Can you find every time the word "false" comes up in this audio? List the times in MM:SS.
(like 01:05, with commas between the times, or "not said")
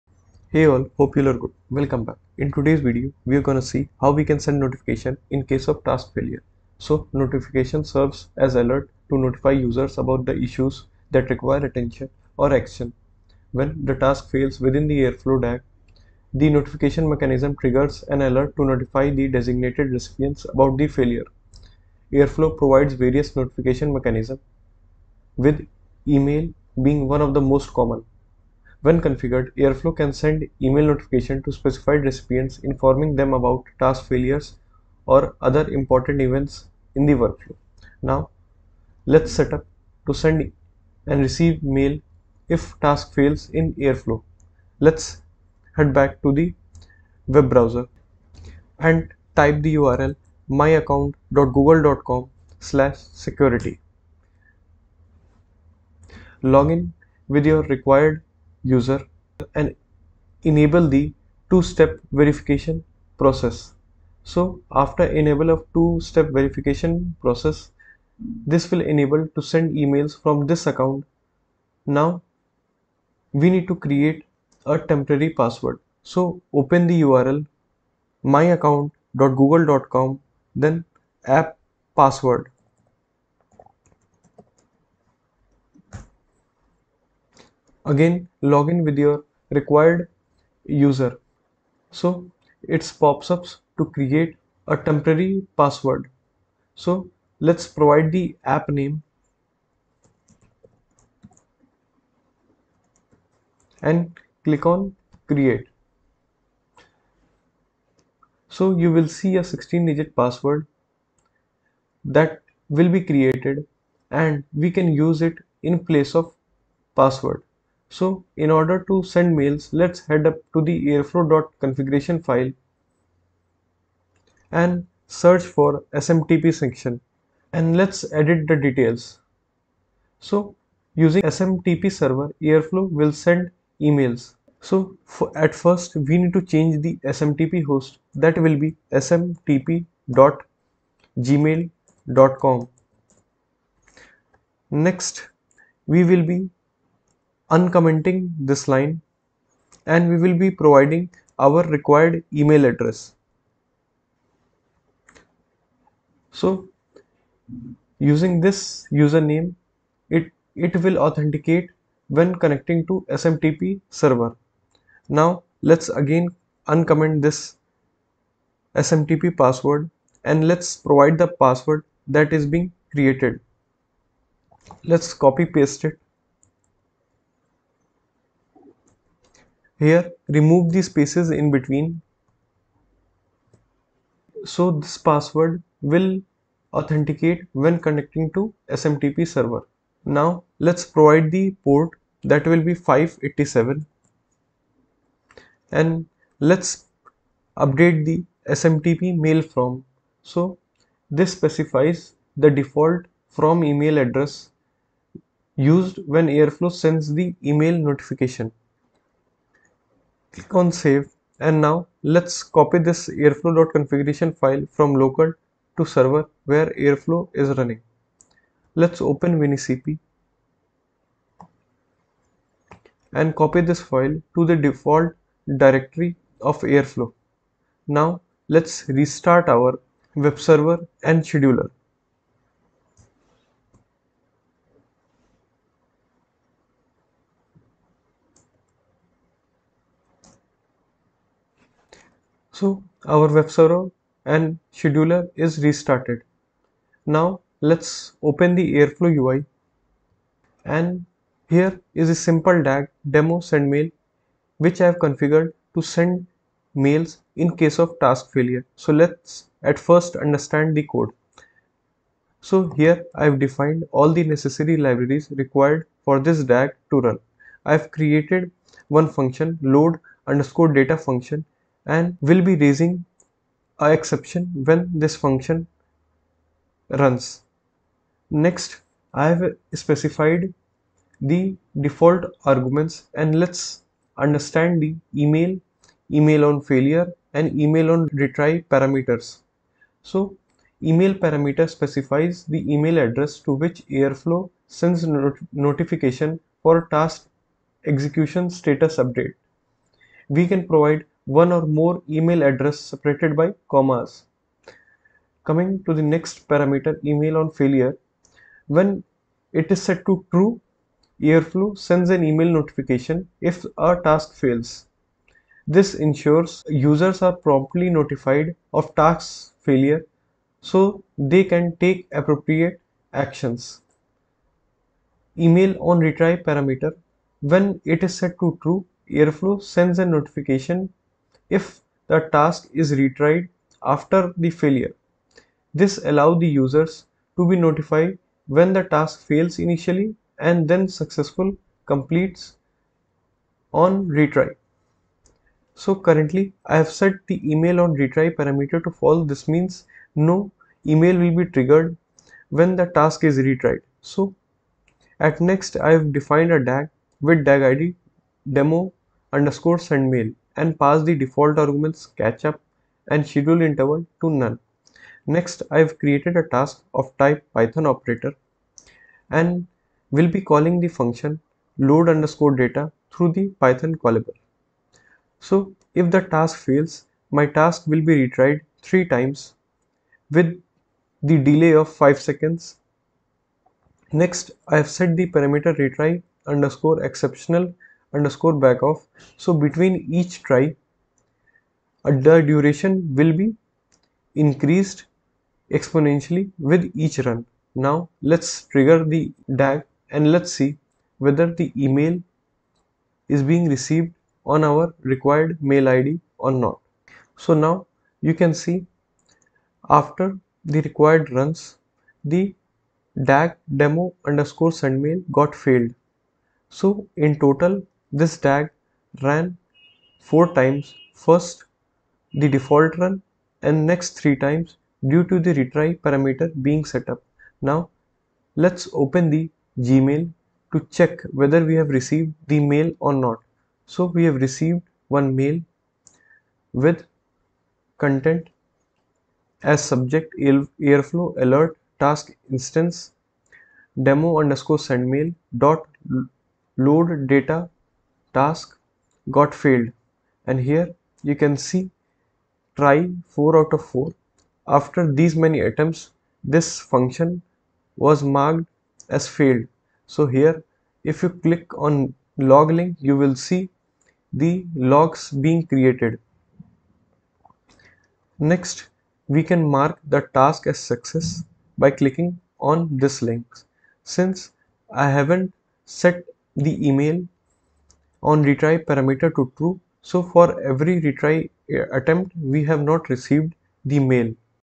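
05:48.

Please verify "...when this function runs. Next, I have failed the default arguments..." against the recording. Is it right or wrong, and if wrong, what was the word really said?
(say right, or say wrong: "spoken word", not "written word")
wrong: "specified", not "failed".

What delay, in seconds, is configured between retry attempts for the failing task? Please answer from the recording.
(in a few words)
5 seconds.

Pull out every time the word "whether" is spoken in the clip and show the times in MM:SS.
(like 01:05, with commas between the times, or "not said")
06:41, 07:11.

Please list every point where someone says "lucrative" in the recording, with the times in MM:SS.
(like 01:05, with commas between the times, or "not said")
not said.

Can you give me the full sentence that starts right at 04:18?
So let's at first understand the code.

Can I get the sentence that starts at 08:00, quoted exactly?
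So for every retry uh, attempt we have not received the mail.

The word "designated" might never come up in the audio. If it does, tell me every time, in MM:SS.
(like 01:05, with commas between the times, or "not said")
00:19.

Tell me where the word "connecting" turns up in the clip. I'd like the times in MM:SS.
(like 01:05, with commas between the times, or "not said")
02:42, 03:07.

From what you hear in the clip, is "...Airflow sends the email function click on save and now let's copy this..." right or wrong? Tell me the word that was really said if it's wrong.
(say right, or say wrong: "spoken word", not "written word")
wrong: "notification", not "function".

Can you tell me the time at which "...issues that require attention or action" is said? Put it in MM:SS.
00:10.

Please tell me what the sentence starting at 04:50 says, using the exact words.
So email parameter specifies the email address to which Airflow sends not notification for task execution status update.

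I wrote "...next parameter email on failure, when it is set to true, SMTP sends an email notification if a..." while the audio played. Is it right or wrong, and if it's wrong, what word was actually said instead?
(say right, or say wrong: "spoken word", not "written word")
wrong: "Airflow", not "SMTP".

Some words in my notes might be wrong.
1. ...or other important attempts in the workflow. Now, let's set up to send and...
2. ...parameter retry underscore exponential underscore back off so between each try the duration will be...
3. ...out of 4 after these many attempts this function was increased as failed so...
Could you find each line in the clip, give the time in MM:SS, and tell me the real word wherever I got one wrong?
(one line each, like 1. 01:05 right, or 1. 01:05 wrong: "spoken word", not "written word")
1. 00:35 wrong: "events", not "attempts"
2. 06:25 right
3. 07:33 wrong: "marked", not "increased".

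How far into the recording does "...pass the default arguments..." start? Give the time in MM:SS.
06:00.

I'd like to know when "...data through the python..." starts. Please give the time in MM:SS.
06:12.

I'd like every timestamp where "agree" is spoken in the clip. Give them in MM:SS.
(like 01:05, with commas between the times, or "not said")
not said.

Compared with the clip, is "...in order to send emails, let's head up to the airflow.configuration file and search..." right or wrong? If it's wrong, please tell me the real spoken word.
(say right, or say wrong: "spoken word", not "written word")
wrong: "mails", not "emails".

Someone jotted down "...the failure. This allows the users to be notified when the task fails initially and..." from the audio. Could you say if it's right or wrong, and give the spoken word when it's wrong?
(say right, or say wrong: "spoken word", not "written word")
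right.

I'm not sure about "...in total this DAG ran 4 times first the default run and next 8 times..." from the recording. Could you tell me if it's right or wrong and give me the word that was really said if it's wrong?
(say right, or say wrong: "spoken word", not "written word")
wrong: "3", not "8".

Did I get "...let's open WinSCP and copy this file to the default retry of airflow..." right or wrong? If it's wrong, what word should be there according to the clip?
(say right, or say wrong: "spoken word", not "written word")
wrong: "directory", not "retry".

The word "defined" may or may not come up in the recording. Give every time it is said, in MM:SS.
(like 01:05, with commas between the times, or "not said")
04:23, 05:56.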